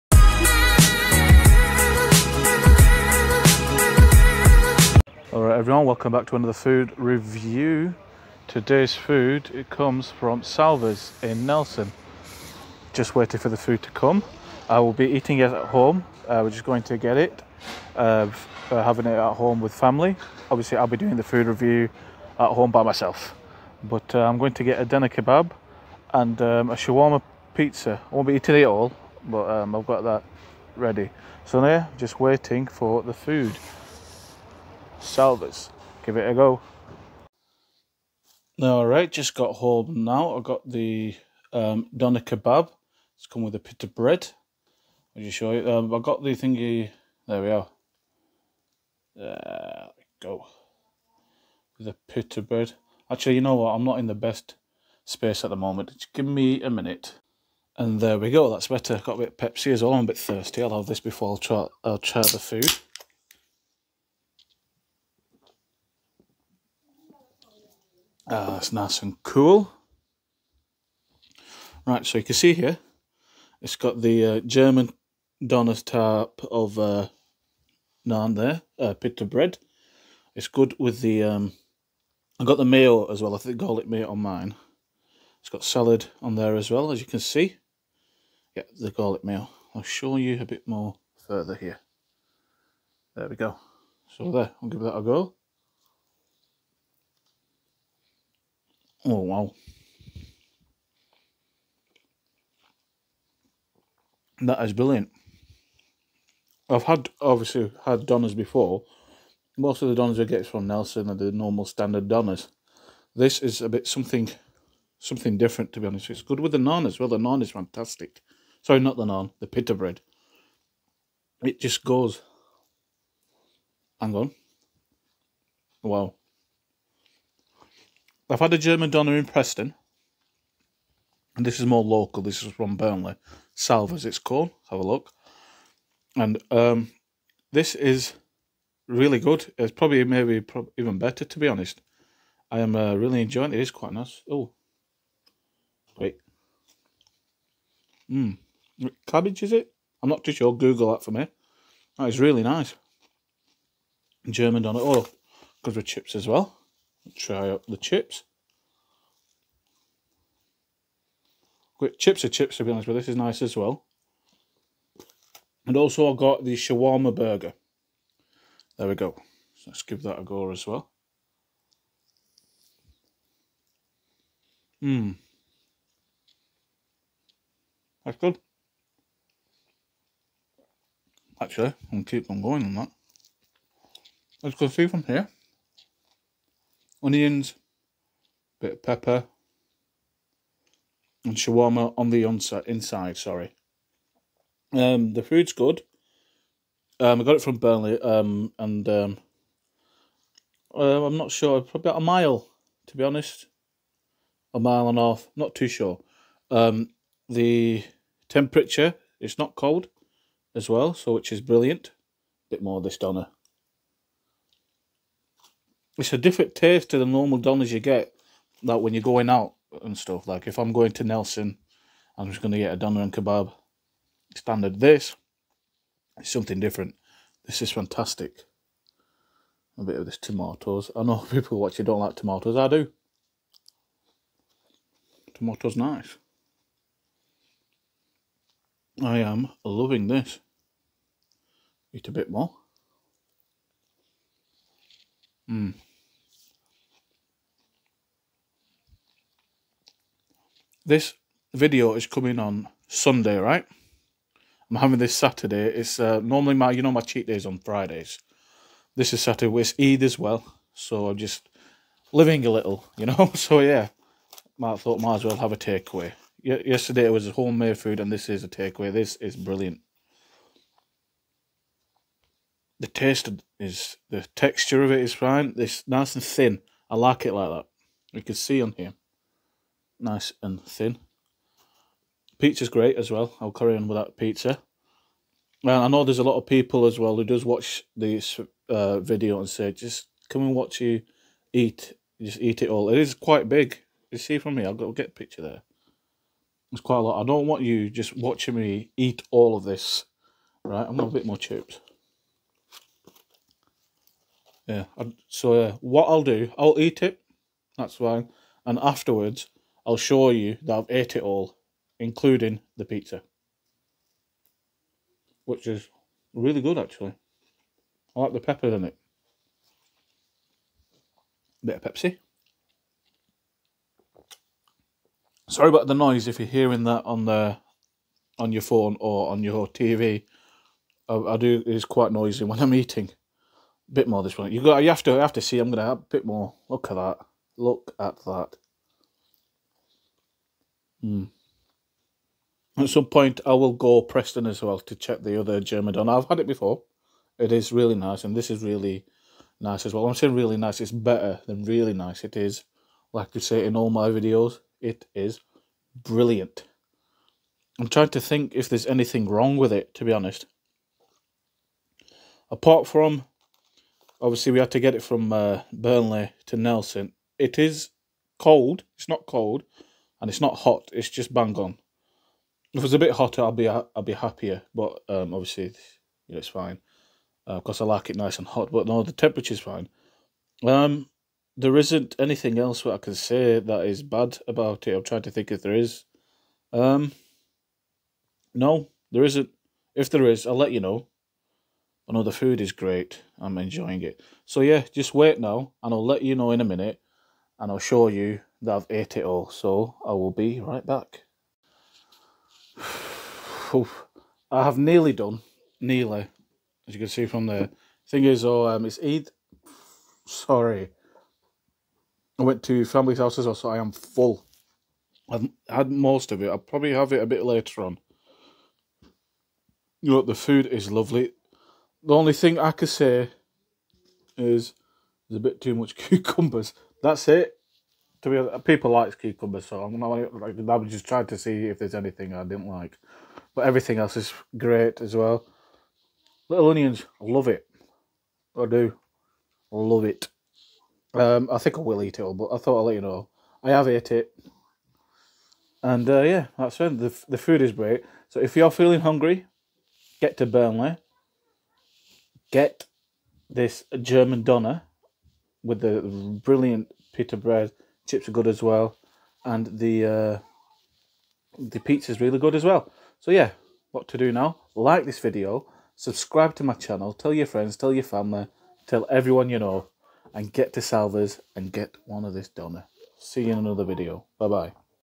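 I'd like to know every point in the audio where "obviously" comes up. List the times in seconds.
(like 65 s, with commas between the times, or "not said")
20 s, 107 s, 364 s, 375 s.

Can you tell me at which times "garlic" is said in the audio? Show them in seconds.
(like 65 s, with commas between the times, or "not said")
83 s, 88 s.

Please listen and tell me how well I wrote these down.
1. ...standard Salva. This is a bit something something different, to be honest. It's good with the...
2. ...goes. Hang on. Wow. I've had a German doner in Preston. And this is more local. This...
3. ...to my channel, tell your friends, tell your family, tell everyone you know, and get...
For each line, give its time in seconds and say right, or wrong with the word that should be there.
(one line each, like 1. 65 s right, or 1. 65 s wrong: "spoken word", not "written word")
1. 111 s wrong: "Donners", not "Salva"
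2. 121 s right
3. 466 s right.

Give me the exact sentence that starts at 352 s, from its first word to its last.
It is, like I say in all my videos, it is brilliant.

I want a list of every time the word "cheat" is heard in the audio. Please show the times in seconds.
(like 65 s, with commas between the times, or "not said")
257 s.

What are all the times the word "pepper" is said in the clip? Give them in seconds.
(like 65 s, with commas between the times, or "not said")
188 s, 318 s.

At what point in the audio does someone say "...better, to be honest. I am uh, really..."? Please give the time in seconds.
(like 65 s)
140 s.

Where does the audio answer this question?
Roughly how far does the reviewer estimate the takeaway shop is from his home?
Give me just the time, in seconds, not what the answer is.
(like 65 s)
204 s.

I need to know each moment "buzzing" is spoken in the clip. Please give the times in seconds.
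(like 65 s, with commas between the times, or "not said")
not said.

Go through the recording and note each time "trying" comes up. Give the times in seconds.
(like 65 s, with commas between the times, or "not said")
357 s, 385 s, 431 s.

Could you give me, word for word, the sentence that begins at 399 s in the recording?
So I will be right back.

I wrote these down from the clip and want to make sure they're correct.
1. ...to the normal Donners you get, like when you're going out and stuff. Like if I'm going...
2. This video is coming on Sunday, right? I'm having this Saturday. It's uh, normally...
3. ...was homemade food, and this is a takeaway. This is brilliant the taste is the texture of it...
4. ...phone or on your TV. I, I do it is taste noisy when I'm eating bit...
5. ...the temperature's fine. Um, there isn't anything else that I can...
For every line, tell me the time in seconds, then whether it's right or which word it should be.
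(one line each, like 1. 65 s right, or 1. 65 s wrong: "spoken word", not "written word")
1. 216 s right
2. 250 s right
3. 267 s right
4. 328 s wrong: "quite", not "taste"
5. 379 s right.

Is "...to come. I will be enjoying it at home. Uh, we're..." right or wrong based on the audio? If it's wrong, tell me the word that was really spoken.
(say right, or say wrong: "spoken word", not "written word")
wrong: "eating", not "enjoying".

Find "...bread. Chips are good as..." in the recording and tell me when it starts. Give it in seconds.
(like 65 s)
457 s.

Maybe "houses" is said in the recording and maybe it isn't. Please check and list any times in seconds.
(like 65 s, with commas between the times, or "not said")
413 s.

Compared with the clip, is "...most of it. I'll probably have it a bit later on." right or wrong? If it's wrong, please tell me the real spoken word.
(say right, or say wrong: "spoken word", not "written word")
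right.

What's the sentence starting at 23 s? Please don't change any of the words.
But uh, I'm going to get a doner kebab and um, a shawarma pizza.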